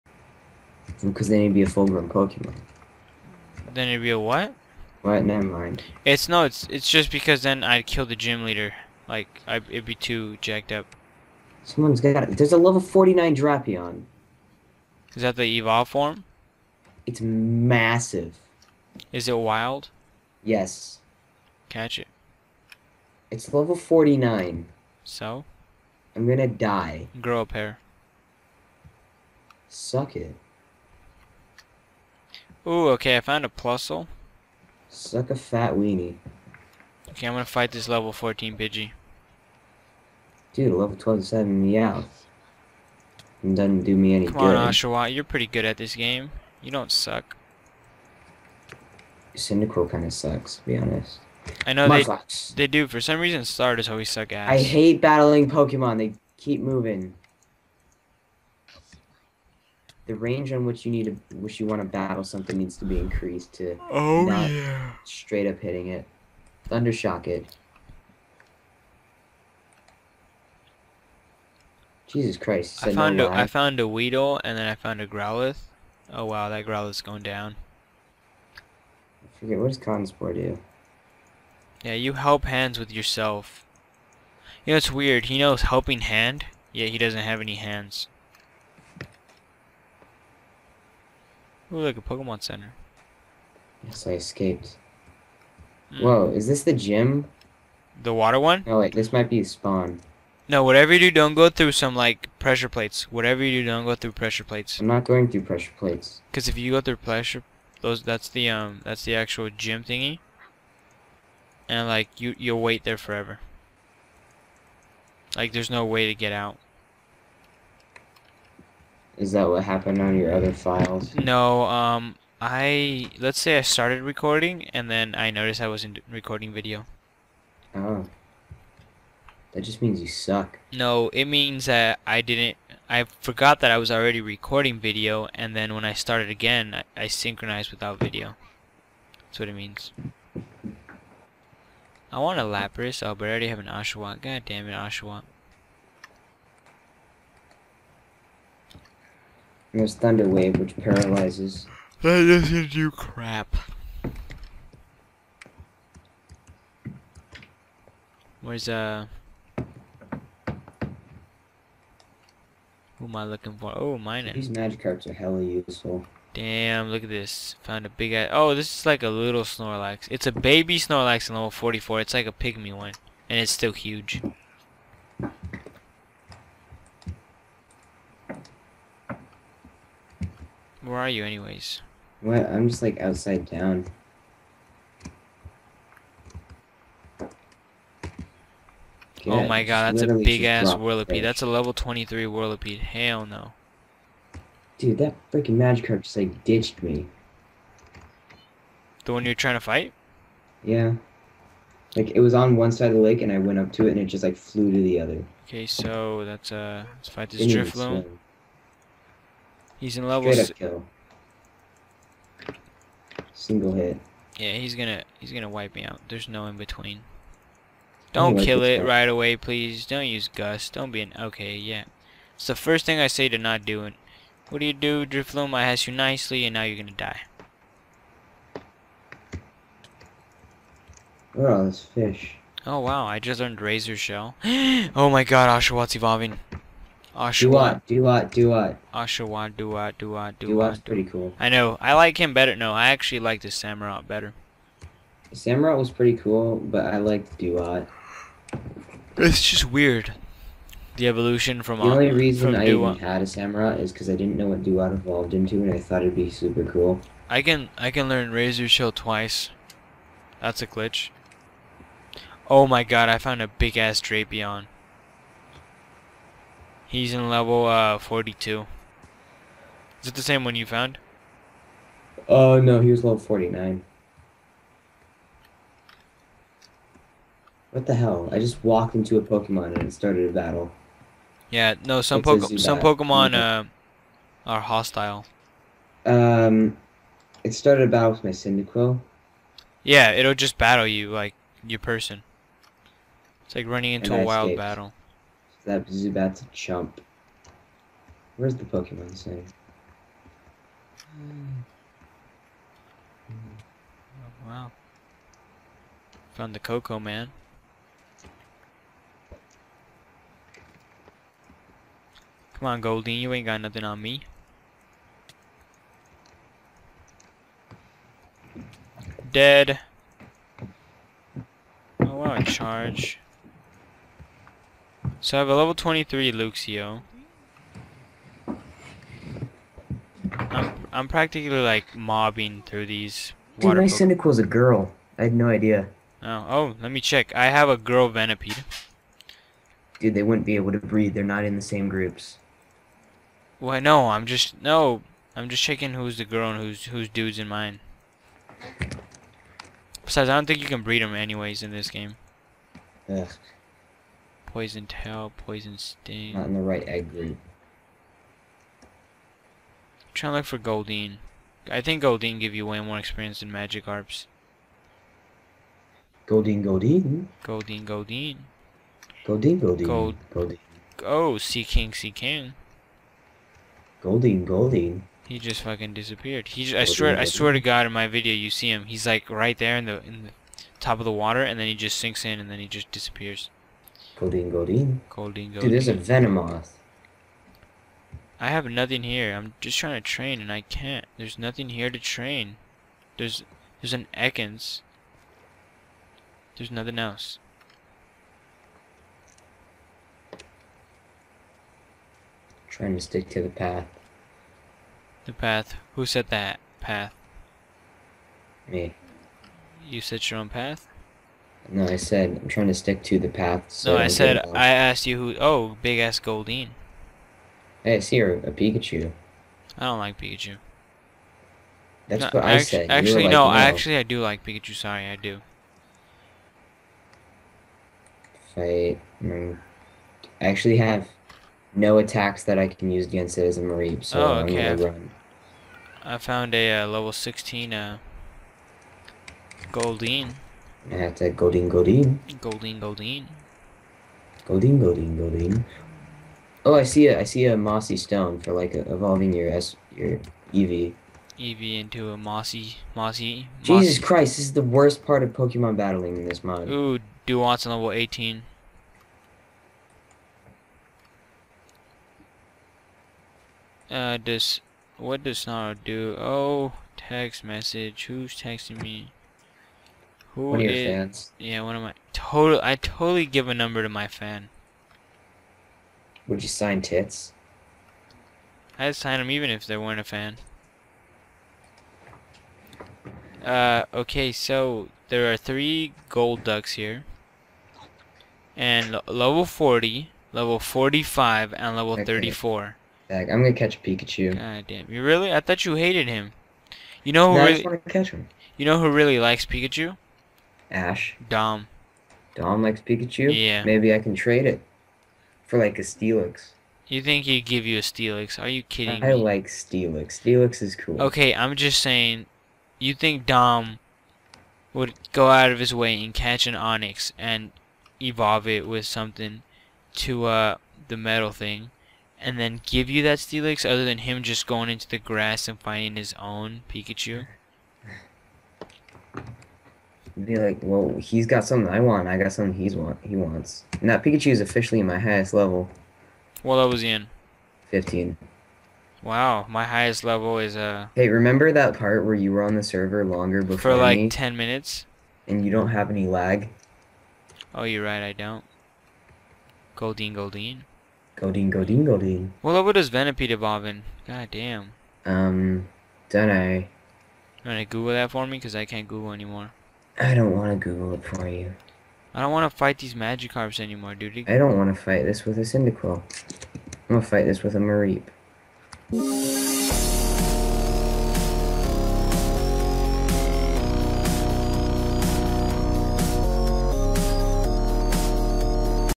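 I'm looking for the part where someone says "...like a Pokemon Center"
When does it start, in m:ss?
1:31.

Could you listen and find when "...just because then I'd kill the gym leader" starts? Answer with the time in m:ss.
0:06.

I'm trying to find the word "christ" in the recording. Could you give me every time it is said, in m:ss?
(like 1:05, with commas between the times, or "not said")
1:12, 7:33.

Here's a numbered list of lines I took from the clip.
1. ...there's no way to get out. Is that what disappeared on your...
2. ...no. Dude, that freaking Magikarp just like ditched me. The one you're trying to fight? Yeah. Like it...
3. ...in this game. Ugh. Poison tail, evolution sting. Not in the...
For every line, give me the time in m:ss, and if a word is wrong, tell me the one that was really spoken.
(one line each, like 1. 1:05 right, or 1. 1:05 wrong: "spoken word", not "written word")
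1. 1:55 wrong: "happened", not "disappeared"
2. 3:13 right
3. 5:51 wrong: "poison", not "evolution".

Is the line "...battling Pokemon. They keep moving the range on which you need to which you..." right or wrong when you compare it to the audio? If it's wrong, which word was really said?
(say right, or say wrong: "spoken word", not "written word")
right.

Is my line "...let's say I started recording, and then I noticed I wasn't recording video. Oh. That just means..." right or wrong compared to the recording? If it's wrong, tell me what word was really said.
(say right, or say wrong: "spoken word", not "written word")
right.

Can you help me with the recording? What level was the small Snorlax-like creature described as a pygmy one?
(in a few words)
44.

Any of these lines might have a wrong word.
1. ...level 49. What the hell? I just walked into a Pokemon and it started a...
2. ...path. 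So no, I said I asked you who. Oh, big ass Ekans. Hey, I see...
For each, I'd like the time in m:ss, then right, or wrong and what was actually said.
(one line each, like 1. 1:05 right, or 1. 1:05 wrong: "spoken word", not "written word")
1. 4:33 right
2. 6:53 wrong: "Goldeen", not "Ekans".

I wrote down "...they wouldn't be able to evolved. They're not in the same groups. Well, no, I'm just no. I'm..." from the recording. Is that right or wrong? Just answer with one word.
wrong.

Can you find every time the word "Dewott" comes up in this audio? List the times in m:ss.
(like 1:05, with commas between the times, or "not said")
4:07, 4:14.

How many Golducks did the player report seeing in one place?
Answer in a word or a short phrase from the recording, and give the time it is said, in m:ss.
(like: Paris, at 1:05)
3, at 8:05.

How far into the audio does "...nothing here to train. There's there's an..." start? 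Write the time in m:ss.
6:31.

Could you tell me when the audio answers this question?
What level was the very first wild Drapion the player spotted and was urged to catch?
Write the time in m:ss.
0:12.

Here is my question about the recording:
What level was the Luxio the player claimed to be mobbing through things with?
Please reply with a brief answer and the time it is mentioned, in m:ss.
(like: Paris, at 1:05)
23, at 5:25.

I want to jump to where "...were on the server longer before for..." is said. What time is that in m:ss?
9:02.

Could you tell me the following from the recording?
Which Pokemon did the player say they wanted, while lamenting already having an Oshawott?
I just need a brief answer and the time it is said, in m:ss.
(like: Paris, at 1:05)
Lapras, at 2:22.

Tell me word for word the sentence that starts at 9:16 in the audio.
You wanna Google that for me?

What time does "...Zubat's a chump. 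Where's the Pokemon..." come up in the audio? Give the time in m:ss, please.
4:55.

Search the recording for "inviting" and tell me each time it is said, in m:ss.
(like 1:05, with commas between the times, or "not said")
not said.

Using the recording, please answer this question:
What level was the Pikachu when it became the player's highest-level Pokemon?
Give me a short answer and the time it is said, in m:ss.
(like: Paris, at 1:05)
15, at 8:57.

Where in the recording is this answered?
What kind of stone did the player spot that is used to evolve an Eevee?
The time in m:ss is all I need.
7:27.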